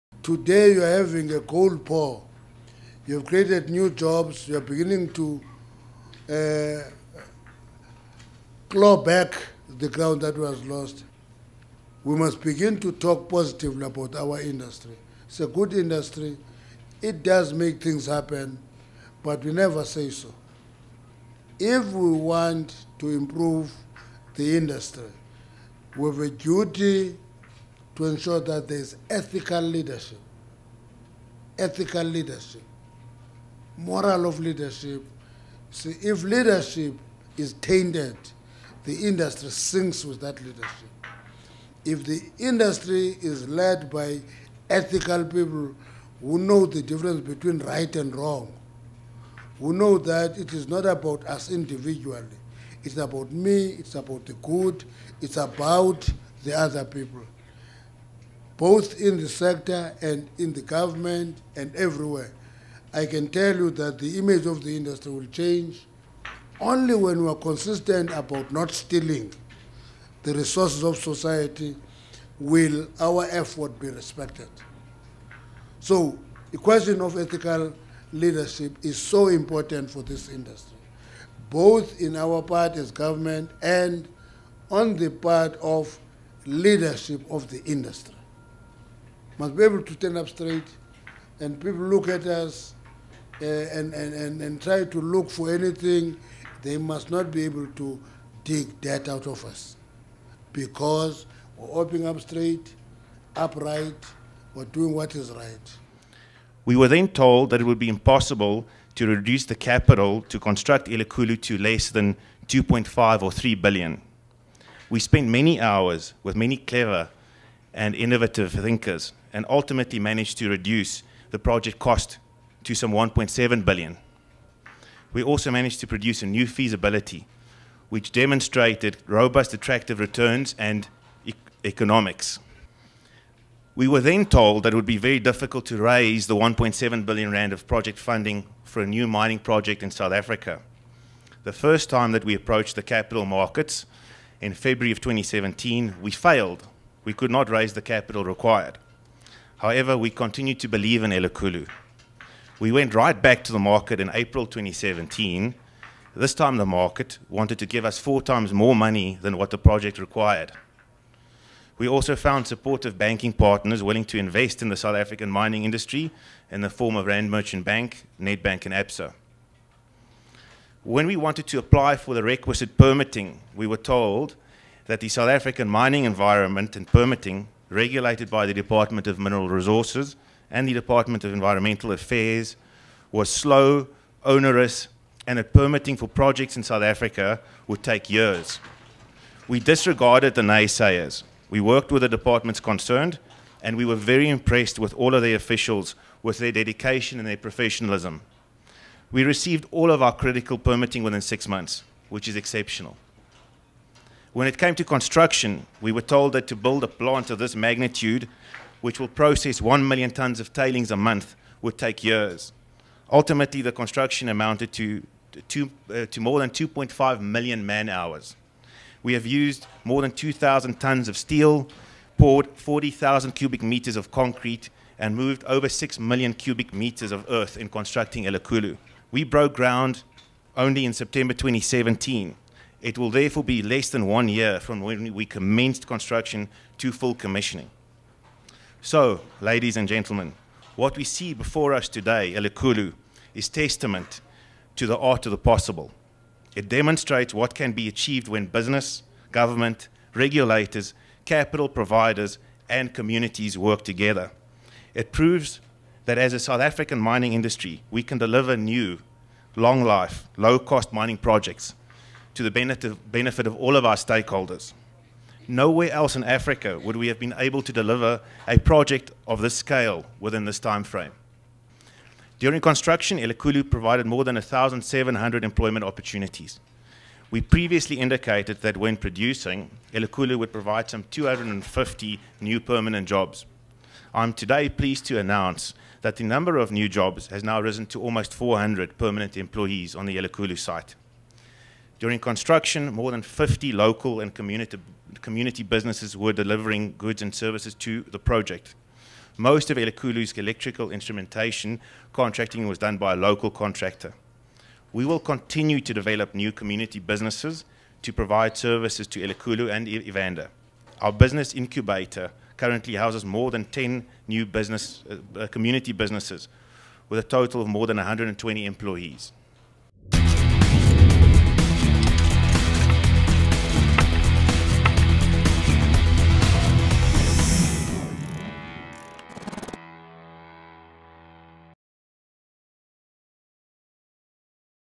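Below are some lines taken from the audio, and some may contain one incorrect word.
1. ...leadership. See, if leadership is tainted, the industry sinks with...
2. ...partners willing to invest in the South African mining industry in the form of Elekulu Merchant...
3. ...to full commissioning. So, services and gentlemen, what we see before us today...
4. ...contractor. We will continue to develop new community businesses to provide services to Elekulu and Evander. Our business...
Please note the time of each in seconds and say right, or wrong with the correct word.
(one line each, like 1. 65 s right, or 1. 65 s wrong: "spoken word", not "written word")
1. 34 s right
2. 163 s wrong: "Rand", not "Elekulu"
3. 236 s wrong: "ladies", not "services"
4. 303 s right.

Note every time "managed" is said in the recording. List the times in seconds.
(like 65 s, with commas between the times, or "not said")
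119 s, 125 s.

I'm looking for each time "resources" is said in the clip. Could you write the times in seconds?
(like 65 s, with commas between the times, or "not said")
70 s, 179 s.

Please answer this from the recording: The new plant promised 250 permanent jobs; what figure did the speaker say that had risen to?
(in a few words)
almost 400.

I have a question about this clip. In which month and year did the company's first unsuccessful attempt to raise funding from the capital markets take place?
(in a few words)
February 2017.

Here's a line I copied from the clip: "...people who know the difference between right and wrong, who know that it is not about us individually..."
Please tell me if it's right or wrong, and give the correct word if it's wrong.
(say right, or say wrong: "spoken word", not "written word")
right.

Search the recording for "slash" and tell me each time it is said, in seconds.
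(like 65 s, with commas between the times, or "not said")
not said.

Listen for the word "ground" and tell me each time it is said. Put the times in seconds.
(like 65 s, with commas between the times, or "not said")
9 s, 229 s.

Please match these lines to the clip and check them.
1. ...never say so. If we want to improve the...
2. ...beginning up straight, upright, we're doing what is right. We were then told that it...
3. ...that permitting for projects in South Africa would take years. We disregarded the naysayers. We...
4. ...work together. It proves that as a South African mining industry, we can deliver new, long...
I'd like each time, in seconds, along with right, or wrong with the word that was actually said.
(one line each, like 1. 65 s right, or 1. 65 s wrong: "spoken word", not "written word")
1. 19 s right
2. 101 s wrong: "opening", not "beginning"
3. 185 s right
4. 253 s right.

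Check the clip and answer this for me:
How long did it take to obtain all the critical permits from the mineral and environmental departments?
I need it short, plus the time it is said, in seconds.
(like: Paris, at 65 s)
6 months, at 201 s.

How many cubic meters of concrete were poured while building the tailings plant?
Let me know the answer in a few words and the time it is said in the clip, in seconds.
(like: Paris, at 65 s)
40,000, at 222 s.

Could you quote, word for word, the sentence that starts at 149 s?
However, we continued to believe in Elikhulu.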